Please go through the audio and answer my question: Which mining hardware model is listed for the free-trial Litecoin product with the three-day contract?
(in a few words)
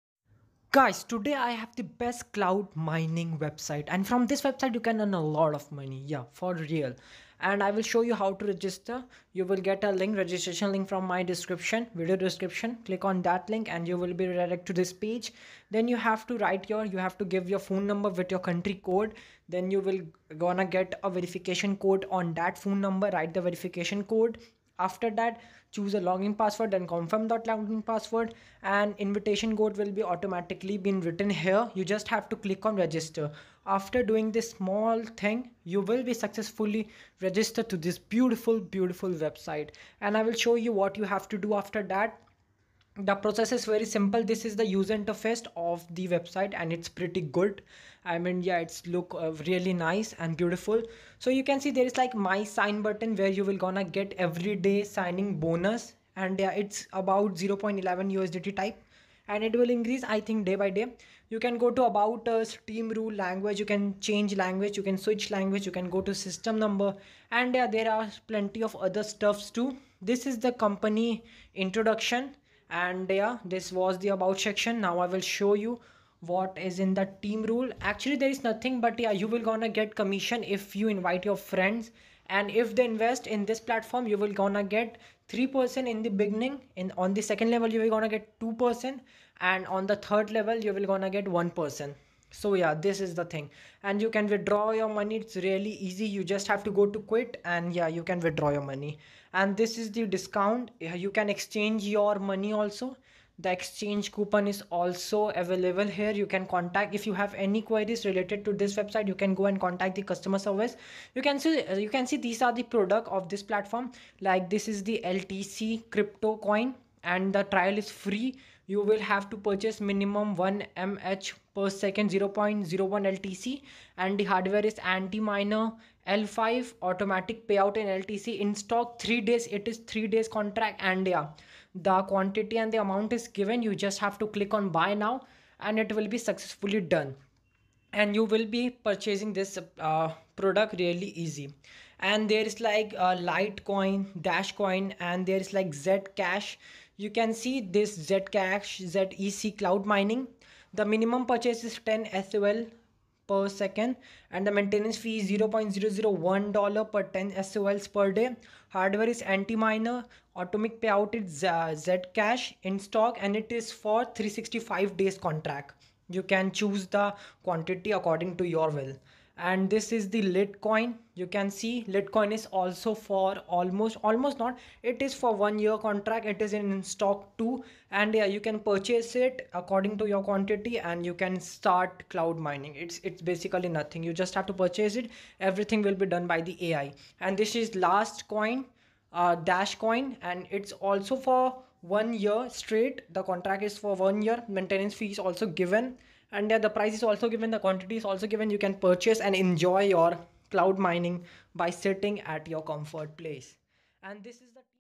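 Antminer L5.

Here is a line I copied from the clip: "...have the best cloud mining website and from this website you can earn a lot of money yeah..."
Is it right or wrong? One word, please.
right.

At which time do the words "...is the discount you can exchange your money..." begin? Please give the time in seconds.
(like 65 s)
99 s.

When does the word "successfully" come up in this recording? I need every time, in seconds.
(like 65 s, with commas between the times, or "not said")
36 s, 136 s.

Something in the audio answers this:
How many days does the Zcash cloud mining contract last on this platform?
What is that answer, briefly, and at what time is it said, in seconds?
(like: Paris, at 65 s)
365 days, at 164 s.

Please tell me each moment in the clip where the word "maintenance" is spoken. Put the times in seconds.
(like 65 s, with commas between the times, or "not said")
154 s, 194 s.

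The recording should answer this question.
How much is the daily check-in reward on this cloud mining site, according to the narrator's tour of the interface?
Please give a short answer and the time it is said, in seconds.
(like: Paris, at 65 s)
0.11 USDT, at 57 s.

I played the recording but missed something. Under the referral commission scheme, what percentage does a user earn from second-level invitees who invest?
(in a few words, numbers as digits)
2%.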